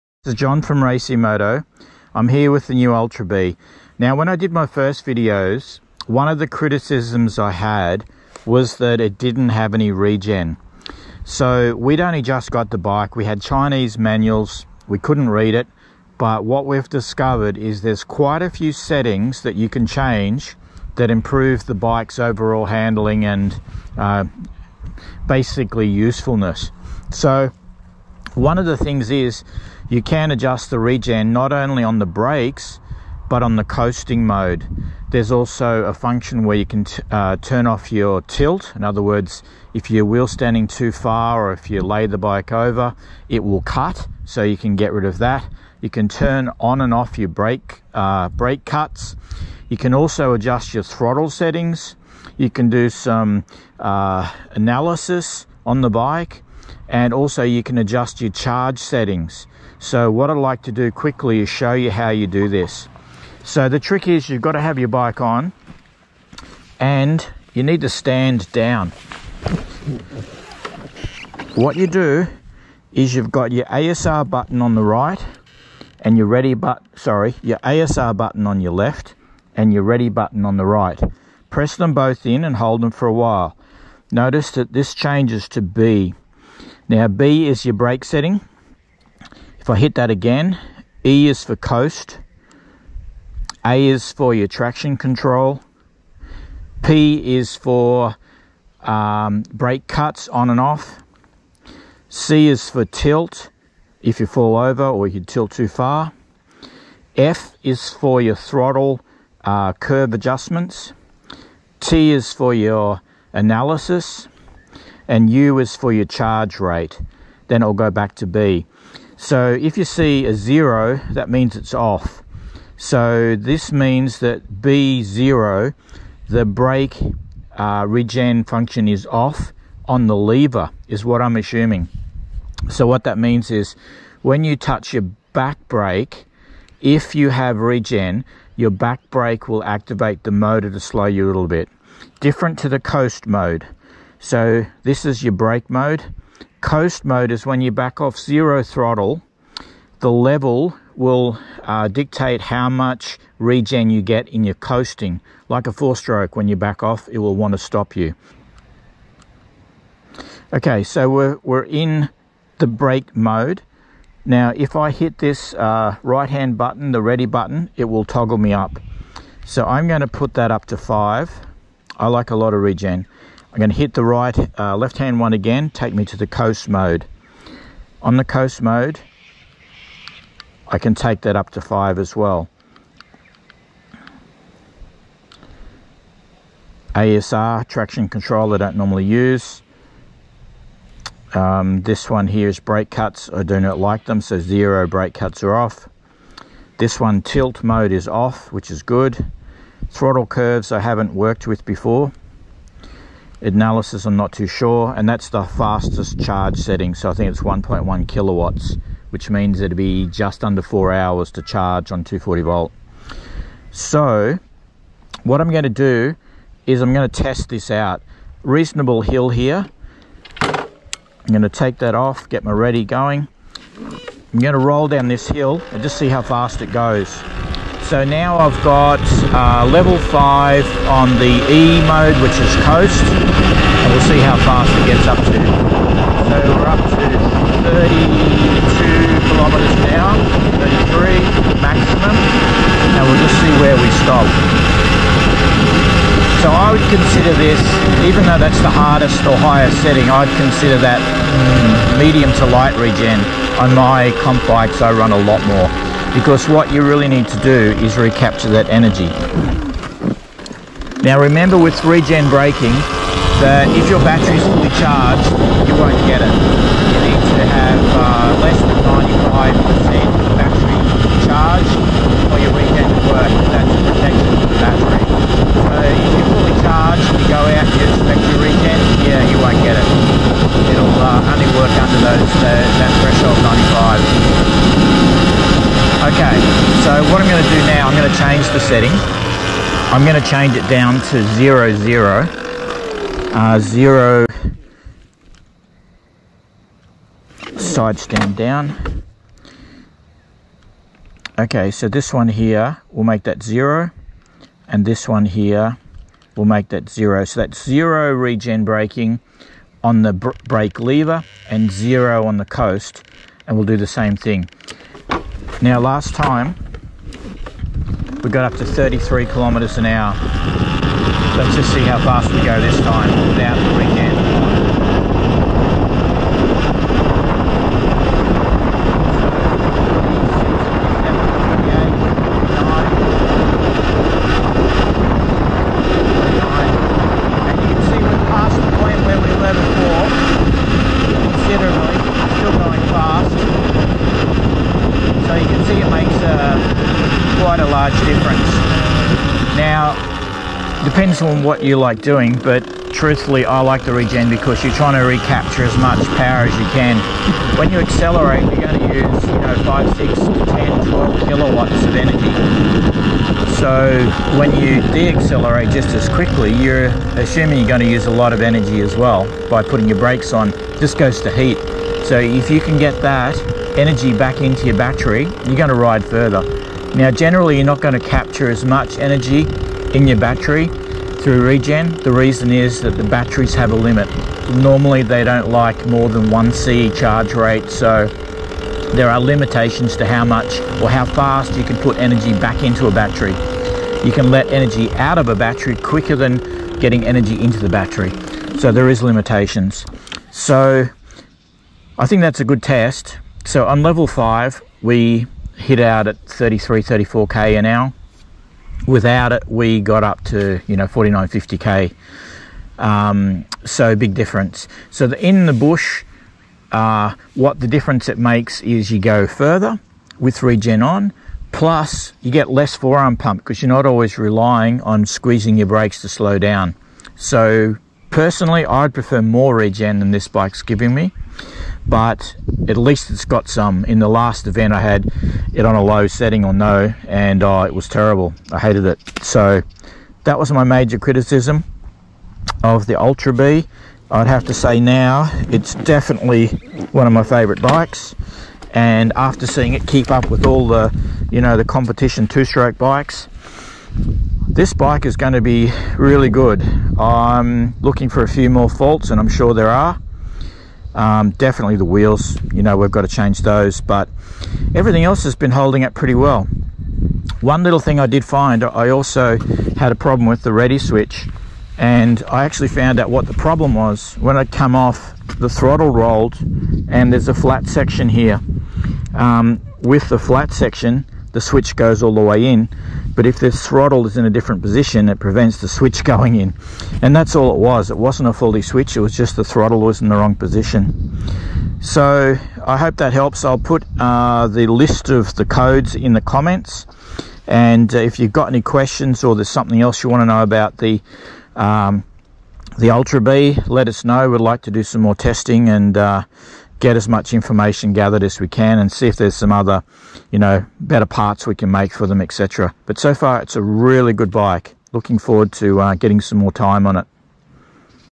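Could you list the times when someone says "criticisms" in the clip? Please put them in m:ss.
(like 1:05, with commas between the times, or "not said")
0:06, 7:20.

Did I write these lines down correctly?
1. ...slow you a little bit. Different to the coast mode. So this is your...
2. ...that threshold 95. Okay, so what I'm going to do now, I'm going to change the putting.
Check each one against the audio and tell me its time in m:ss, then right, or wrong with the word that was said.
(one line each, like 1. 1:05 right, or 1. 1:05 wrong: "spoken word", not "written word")
1. 2:20 right
2. 4:42 wrong: "setting", not "putting".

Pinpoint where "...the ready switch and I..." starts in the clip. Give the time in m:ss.
7:50.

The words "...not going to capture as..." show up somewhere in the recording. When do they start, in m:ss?
6:17.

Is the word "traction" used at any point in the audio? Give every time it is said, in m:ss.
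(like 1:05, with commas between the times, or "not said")
1:34, 3:07.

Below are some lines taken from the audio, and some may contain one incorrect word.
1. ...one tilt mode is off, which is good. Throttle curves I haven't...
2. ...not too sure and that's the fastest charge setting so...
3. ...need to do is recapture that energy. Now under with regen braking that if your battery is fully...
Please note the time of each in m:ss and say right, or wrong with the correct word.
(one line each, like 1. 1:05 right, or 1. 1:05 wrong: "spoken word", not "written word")
1. 3:17 right
2. 3:24 right
3. 4:17 wrong: "remember", not "under".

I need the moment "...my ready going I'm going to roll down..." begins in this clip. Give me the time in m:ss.
3:42.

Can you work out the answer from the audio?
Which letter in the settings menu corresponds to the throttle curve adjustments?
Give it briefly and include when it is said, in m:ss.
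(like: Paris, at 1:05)
F, at 1:47.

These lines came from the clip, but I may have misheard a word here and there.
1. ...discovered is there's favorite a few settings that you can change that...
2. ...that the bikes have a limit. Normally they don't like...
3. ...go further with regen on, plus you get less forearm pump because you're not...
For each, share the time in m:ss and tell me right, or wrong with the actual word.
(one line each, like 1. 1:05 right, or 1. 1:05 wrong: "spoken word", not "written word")
1. 0:16 wrong: "quite", not "favorite"
2. 6:22 wrong: "batteries", not "bikes"
3. 6:58 right.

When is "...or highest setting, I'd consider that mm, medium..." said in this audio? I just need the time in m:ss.
4:09.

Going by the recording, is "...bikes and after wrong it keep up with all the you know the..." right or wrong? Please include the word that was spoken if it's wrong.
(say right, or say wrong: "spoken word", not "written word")
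wrong: "seeing", not "wrong".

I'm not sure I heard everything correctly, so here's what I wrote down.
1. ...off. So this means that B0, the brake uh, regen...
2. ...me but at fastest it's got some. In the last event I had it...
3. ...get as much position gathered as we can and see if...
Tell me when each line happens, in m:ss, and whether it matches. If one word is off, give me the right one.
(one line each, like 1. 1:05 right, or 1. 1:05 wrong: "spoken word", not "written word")
1. 2:01 right
2. 7:10 wrong: "least", not "fastest"
3. 8:26 wrong: "information", not "position".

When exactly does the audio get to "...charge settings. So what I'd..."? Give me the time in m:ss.
0:58.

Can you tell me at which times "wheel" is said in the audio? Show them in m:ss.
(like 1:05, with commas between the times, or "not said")
0:40, 7:41.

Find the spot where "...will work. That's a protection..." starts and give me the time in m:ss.
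4:32.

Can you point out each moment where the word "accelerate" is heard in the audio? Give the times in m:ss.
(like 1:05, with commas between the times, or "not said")
5:57, 6:04.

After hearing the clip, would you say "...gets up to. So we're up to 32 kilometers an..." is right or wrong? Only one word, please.
right.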